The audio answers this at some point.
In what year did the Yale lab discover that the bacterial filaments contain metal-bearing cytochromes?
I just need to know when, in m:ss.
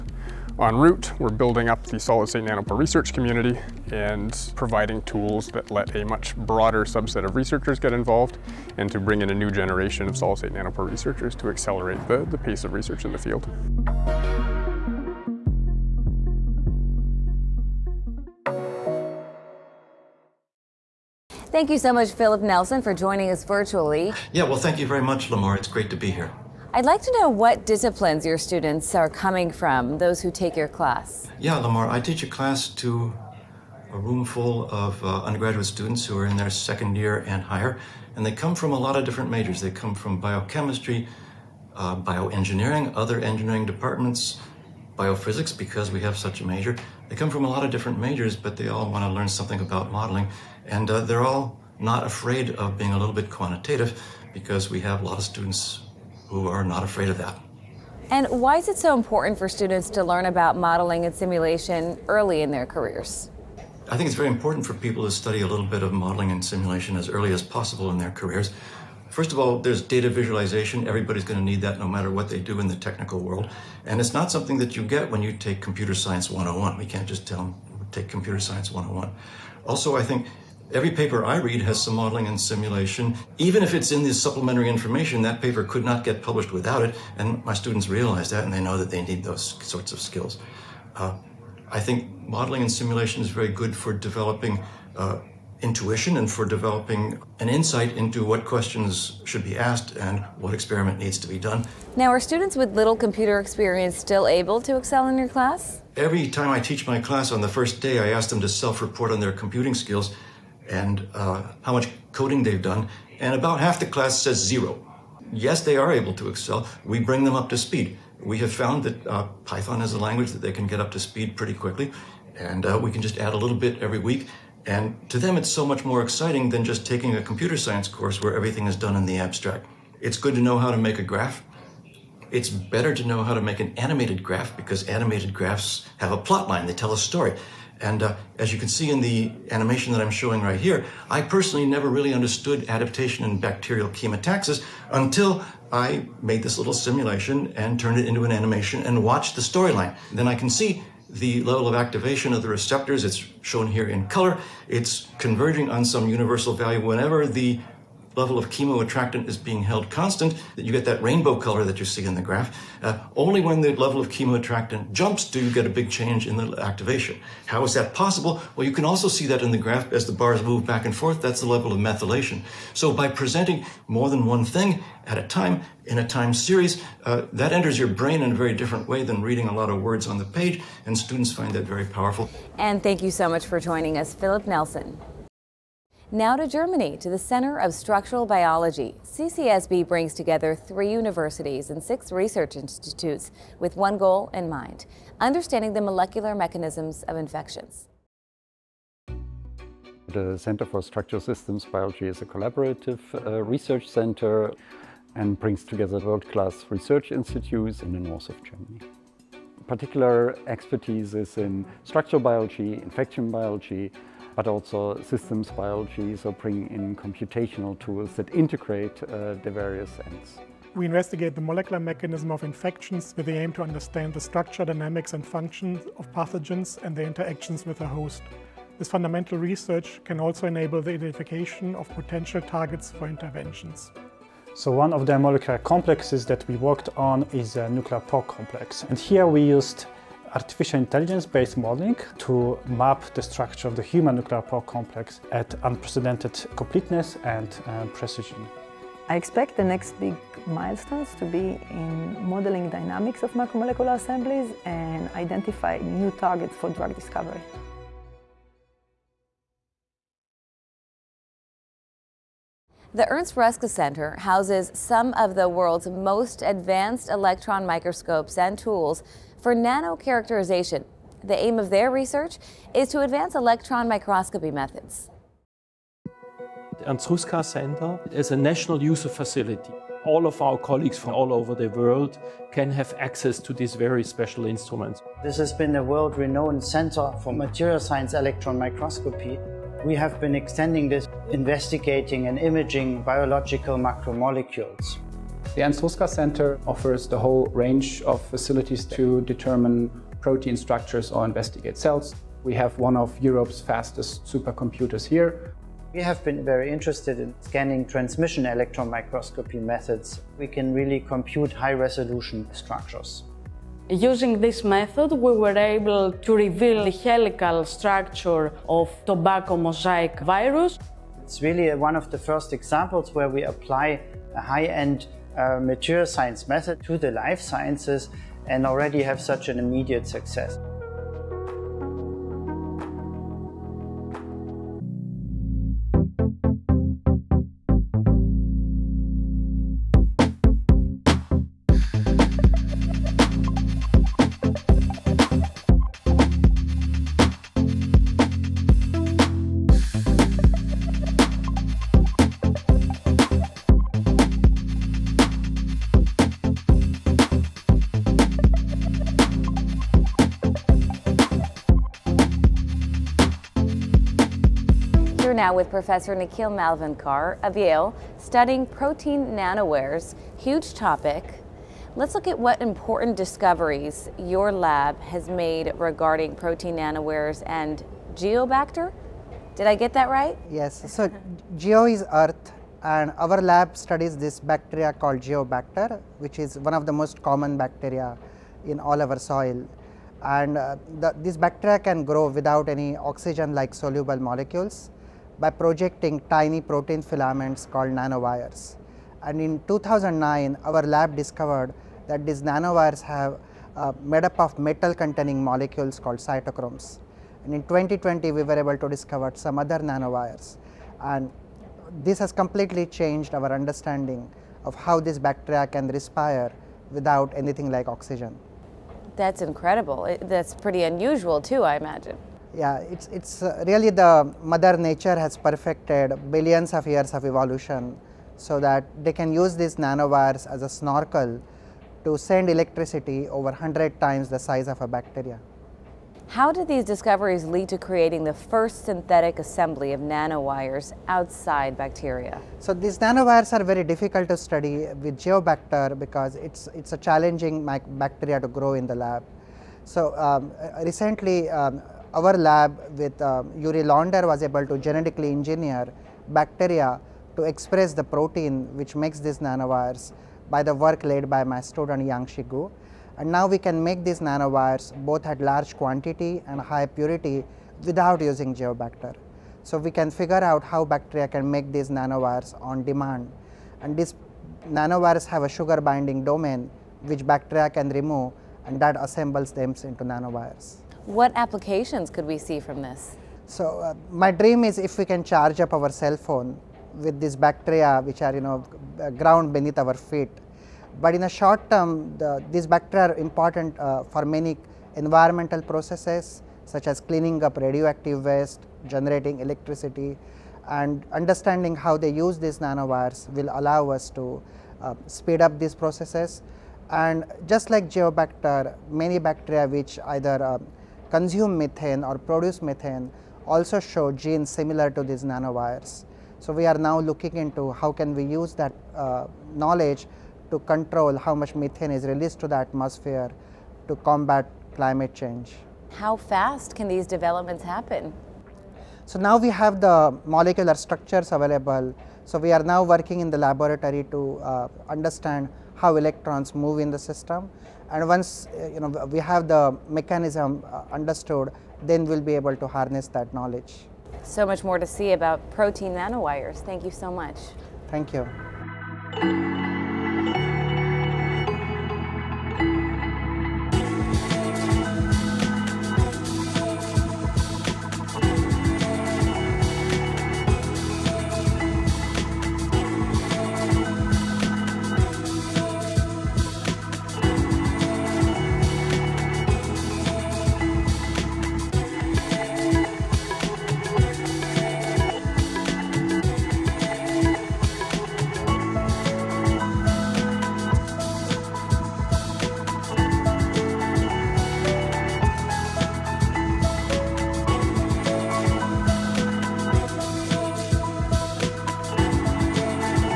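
6:39.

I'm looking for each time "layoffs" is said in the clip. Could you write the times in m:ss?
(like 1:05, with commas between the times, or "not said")
not said.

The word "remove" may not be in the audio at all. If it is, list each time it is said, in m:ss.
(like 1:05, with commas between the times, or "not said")
7:57.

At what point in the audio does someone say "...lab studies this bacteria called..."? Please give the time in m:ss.
6:23.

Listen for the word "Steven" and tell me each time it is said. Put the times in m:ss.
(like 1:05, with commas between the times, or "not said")
not said.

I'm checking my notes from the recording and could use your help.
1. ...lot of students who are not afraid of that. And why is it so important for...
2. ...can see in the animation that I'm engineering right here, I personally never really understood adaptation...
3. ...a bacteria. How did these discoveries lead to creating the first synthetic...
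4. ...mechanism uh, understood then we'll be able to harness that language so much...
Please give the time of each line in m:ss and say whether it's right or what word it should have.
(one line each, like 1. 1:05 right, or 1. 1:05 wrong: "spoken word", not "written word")
1. 0:55 right
2. 2:18 wrong: "showing", not "engineering"
3. 7:14 right
4. 8:59 wrong: "knowledge", not "language".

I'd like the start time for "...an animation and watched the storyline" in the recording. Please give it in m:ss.
2:28.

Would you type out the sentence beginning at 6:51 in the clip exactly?
And this has completely changed our understanding of how this bacteria can respire without anything like oxygen.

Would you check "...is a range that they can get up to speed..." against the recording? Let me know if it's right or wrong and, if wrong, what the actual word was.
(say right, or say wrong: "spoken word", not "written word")
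wrong: "language", not "range".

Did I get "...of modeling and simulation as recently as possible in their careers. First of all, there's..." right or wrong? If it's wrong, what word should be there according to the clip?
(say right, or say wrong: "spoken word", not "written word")
wrong: "early", not "recently".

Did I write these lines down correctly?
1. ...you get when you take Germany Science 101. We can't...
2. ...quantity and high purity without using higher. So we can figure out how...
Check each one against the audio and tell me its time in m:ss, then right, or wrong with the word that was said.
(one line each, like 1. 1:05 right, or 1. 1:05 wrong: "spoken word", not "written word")
1. 1:14 wrong: "Computer", not "Germany"
2. 7:45 wrong: "geobacter", not "higher".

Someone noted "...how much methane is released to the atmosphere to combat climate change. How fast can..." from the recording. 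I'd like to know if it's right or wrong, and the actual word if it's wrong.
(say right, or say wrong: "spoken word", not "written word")
right.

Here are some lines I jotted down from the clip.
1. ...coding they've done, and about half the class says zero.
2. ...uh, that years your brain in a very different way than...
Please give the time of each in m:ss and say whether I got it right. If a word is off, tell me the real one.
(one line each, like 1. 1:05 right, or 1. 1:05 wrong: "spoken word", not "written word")
1. 1:52 right
2. 2:57 wrong: "enters", not "years".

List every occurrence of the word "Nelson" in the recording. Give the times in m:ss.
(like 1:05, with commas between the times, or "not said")
0:22, 3:04.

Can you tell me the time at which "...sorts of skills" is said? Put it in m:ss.
1:29.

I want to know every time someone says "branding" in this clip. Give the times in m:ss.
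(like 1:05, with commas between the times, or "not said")
not said.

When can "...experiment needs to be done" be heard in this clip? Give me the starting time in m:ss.
1:40.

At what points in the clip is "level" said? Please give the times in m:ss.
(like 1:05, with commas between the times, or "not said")
2:31, 2:38, 2:43, 2:51.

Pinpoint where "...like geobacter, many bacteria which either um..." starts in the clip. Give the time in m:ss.
8:27.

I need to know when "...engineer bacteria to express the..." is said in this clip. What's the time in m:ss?
7:35.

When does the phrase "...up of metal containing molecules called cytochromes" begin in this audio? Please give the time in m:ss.
6:44.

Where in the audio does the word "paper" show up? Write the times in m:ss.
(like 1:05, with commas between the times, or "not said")
1:20, 1:25.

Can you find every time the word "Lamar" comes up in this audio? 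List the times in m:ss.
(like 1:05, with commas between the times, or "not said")
0:25, 0:31.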